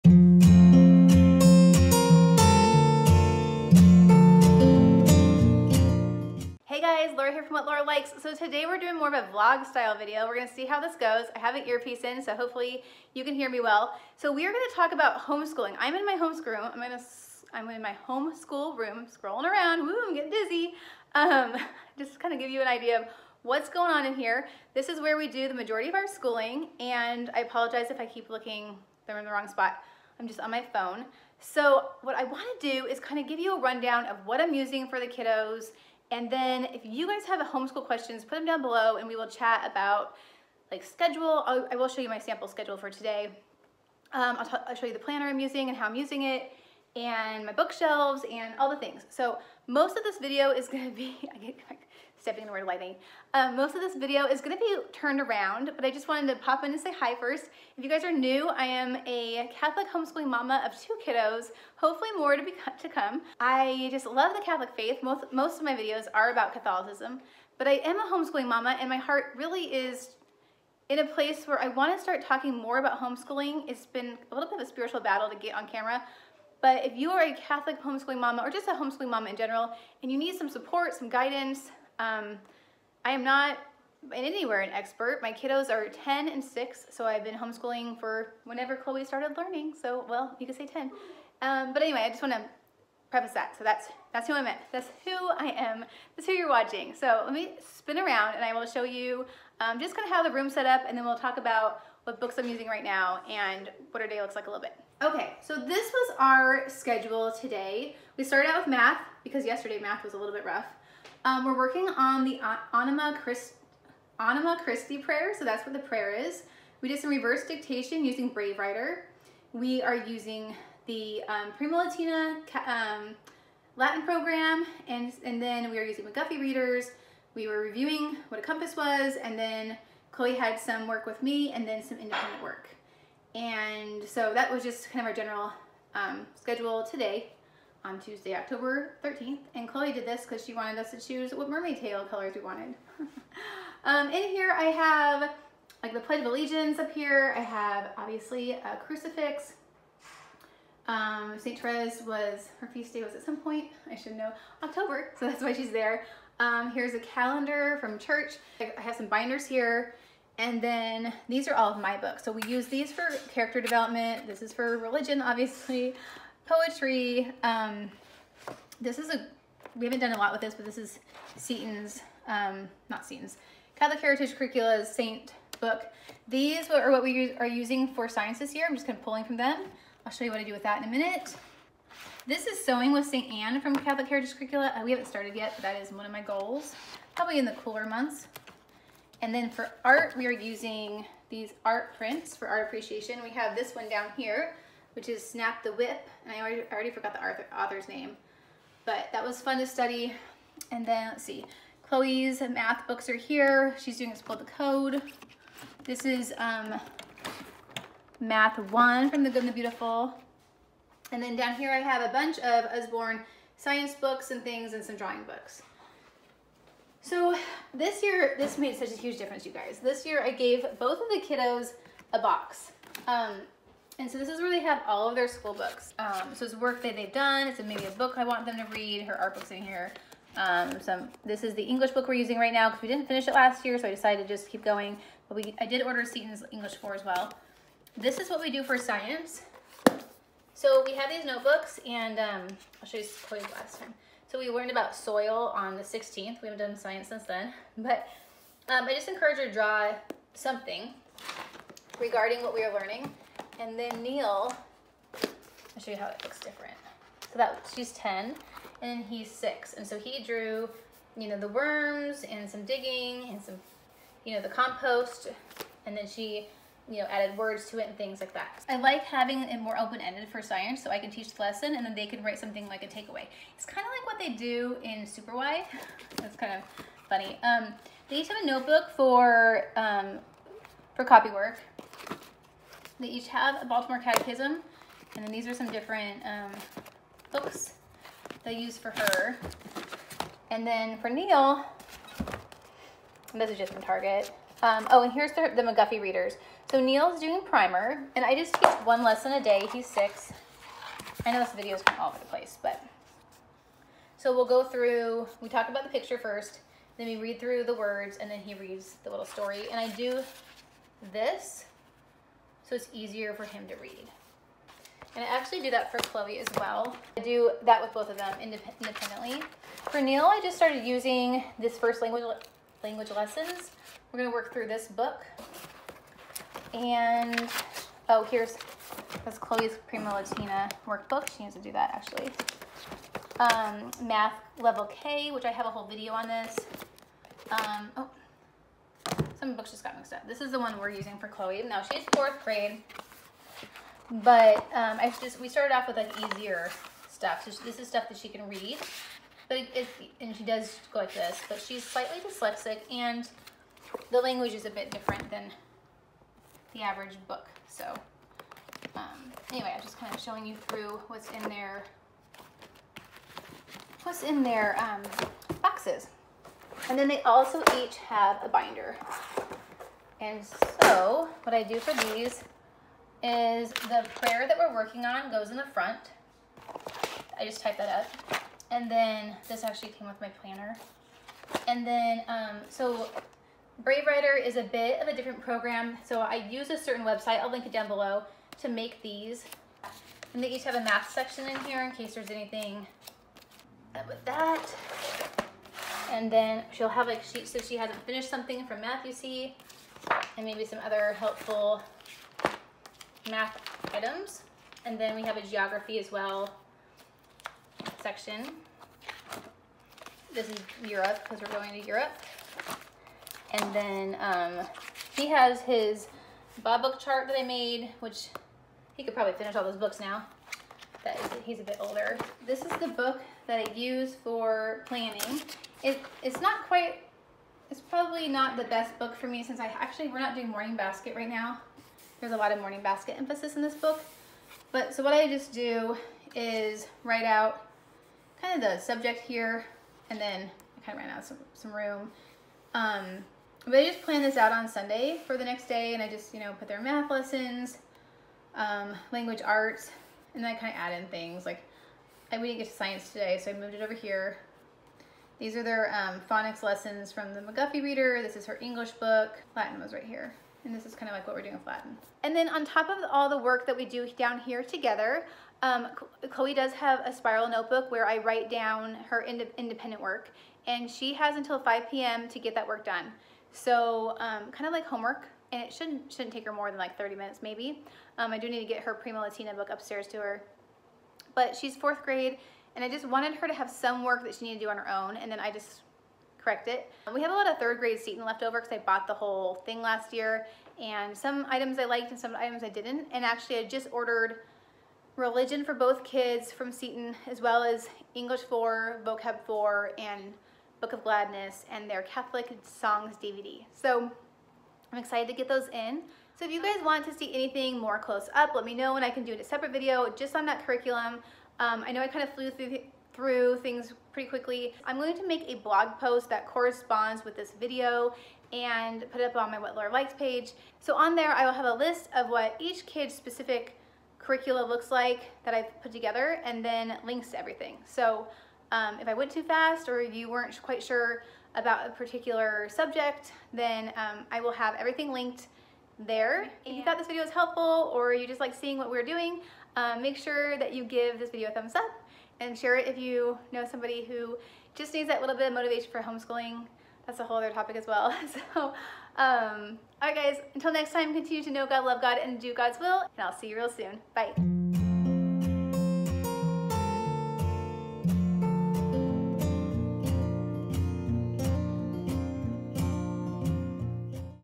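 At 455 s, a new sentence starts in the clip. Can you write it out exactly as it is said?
These are their um, phonics lessons from the McGuffey Reader.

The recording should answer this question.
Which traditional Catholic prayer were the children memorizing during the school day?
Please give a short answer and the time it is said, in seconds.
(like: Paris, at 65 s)
Anima Christi, at 114 s.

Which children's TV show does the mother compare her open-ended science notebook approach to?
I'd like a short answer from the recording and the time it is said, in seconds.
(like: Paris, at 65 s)
Super Why, at 275 s.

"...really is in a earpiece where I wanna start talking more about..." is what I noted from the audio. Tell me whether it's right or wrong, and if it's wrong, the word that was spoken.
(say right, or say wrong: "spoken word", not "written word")
wrong: "place", not "earpiece".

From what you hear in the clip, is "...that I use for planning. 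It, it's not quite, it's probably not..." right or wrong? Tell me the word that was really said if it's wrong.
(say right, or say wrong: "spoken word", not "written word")
right.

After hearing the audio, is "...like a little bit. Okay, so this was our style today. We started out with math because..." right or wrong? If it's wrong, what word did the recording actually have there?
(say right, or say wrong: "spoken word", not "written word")
wrong: "schedule", not "style".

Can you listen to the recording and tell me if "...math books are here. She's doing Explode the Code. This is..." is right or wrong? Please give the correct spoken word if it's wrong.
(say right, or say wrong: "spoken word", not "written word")
right.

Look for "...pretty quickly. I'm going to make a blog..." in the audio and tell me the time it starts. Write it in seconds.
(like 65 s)
514 s.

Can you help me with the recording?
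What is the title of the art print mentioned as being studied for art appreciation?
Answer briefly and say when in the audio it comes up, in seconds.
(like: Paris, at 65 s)
Snap the Whip, at 195 s.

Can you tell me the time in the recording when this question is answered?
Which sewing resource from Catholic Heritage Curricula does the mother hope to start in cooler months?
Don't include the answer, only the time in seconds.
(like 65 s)
182 s.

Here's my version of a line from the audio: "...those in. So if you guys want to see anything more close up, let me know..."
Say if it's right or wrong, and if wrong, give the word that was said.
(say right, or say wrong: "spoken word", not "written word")
right.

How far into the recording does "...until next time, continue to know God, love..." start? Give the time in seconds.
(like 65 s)
550 s.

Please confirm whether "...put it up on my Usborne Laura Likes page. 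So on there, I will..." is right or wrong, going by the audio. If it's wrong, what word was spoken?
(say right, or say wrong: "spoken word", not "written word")
wrong: "What", not "Usborne".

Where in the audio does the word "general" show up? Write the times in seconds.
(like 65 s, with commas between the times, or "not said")
79 s, 135 s.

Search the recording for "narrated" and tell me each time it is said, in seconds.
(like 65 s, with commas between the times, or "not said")
not said.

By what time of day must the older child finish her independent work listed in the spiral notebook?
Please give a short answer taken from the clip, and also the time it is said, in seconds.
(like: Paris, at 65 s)
5 p.m., at 471 s.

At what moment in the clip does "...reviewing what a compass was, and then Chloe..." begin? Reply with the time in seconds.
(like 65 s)
127 s.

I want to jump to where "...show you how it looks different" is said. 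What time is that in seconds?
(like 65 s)
255 s.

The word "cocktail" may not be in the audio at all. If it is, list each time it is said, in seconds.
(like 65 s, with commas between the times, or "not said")
not said.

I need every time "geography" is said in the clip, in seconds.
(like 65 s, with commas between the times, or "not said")
405 s.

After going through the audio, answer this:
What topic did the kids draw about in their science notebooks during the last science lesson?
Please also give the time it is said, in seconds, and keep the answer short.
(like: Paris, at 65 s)
Soil, at 244 s.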